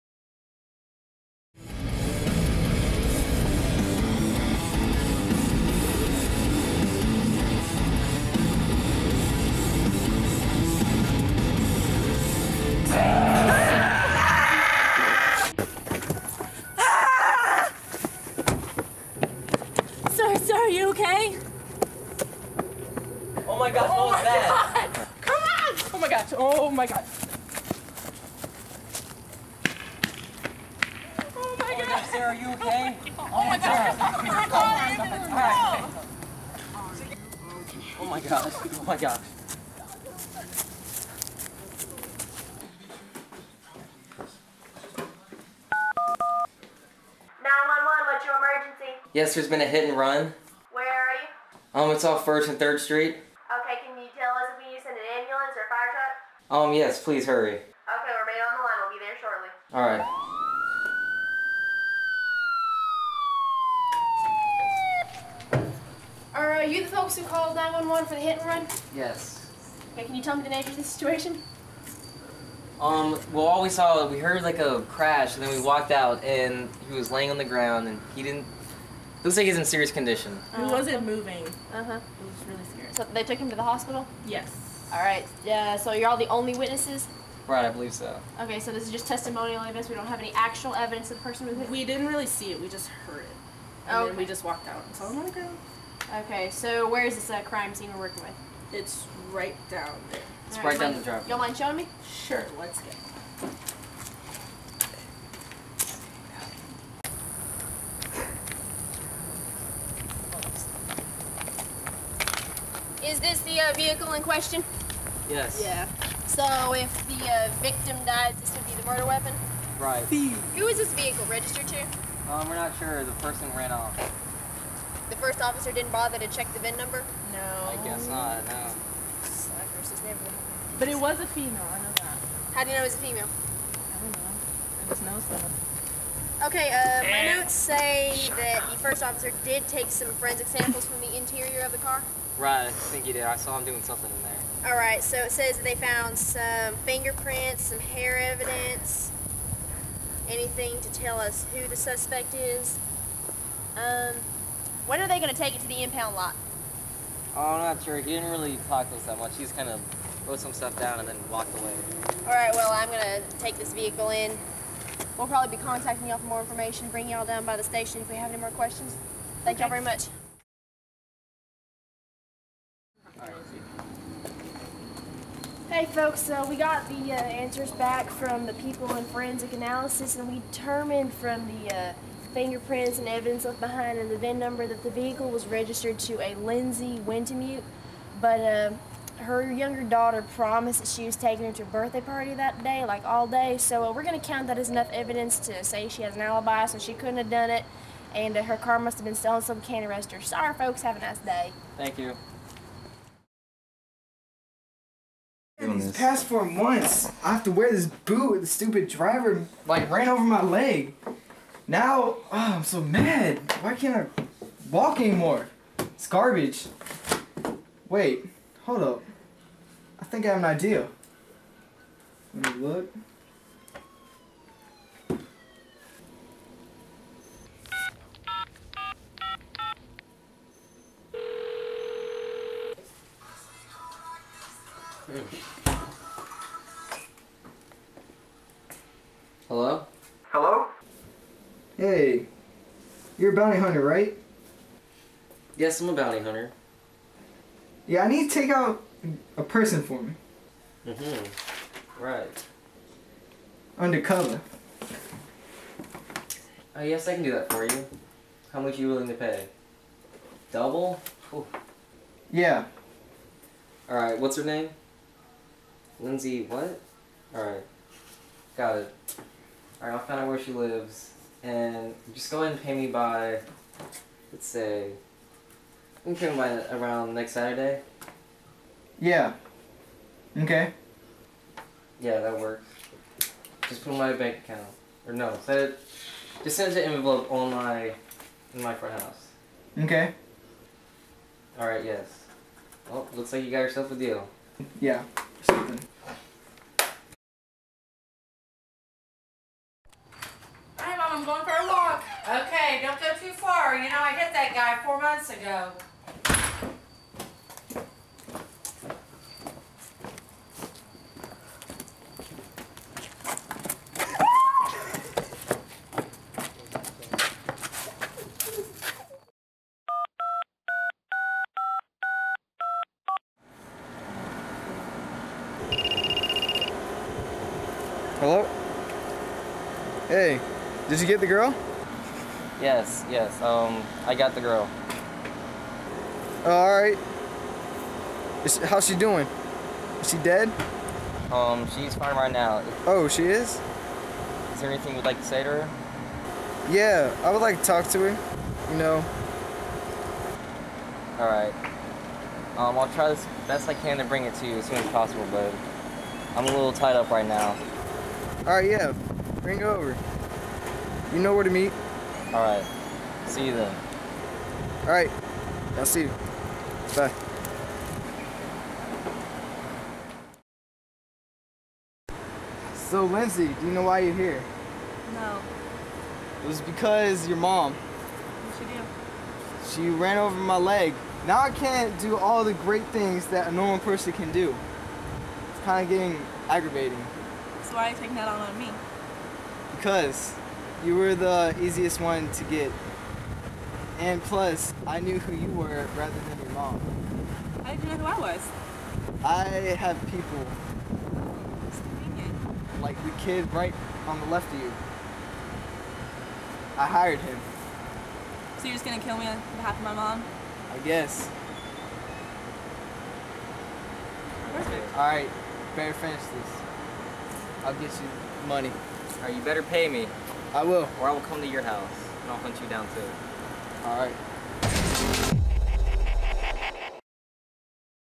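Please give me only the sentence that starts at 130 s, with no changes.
But it was a female, I know that.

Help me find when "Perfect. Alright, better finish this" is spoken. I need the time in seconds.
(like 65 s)
414 s.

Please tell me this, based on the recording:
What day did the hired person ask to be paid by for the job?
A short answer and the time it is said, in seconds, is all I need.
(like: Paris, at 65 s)
Next Saturday, at 277 s.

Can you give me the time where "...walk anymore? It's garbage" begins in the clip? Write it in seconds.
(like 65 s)
214 s.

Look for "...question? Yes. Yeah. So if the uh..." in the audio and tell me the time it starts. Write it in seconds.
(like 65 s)
114 s.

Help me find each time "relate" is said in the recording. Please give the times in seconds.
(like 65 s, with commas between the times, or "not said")
not said.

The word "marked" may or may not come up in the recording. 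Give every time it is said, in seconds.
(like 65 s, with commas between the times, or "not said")
not said.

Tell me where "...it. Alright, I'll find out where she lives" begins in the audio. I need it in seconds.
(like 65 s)
268 s.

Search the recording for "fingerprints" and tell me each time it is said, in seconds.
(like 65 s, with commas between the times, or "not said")
146 s, 182 s.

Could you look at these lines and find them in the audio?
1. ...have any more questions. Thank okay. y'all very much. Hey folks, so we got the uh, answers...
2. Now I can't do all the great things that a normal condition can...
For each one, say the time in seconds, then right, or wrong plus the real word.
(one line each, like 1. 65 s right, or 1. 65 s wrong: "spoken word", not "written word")
1. 168 s right
2. 381 s wrong: "person", not "condition".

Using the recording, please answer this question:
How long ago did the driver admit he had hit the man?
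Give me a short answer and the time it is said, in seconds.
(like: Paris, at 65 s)
4 months, at 304 s.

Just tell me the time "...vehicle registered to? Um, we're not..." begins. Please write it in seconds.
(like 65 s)
120 s.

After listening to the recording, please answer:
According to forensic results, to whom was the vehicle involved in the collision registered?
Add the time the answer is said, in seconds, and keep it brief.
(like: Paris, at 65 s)
Lindsey Wintemute, at 186 s.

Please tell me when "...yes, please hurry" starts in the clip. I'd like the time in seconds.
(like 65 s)
56 s.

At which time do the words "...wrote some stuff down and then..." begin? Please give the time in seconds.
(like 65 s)
160 s.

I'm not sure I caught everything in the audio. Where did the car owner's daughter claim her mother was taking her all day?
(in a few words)
A birthday party.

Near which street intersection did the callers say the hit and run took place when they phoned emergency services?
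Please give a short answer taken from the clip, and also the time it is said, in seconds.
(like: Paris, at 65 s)
First and Third Street, at 52 s.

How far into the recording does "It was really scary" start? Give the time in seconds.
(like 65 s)
81 s.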